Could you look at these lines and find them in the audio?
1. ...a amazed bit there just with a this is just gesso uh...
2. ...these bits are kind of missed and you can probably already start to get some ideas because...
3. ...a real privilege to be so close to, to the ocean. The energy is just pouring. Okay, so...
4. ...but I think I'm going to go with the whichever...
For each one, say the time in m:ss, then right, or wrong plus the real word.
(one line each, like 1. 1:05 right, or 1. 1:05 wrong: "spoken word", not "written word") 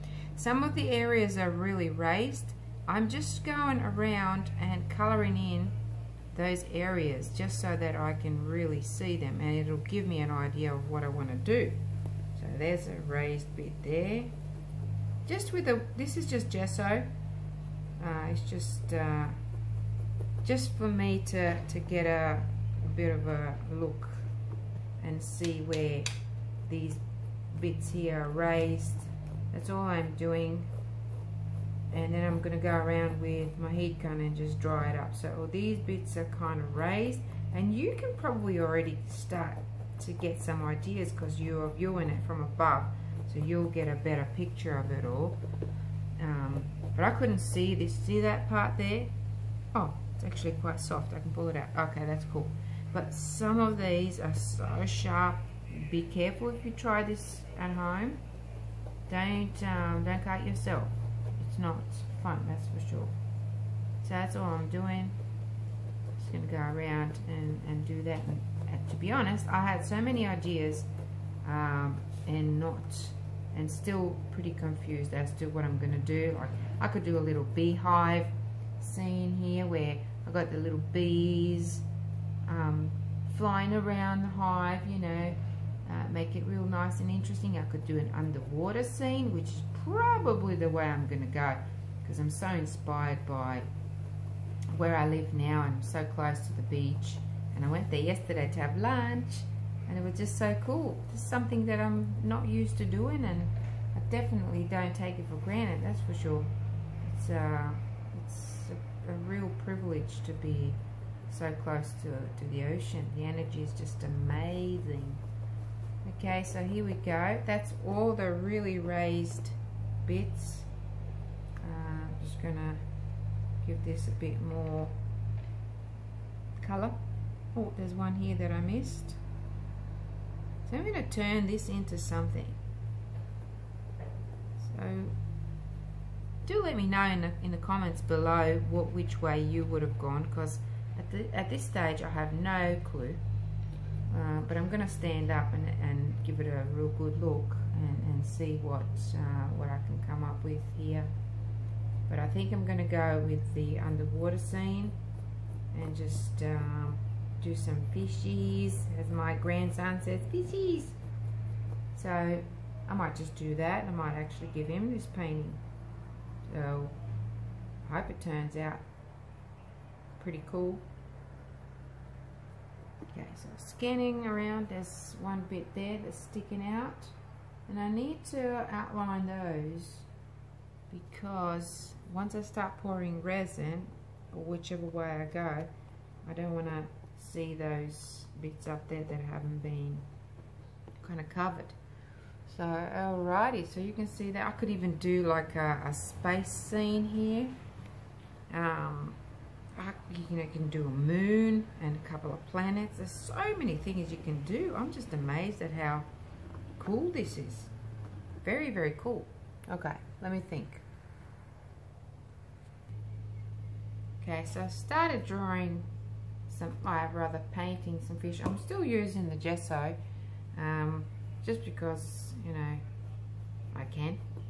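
1. 0:12 wrong: "raised", not "amazed"
2. 0:35 wrong: "raised", not "missed"
3. 1:49 wrong: "amazing", not "pouring"
4. 2:32 wrong: "underwater", not "whichever".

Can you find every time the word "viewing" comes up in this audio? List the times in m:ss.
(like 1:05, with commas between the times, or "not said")
0:41.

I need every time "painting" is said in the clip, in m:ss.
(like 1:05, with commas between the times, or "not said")
2:45, 3:37.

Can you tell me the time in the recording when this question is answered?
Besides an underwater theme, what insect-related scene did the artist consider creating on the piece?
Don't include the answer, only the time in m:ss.
1:17.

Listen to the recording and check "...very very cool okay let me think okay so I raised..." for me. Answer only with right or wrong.
wrong.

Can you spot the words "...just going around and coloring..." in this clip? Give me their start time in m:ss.
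0:03.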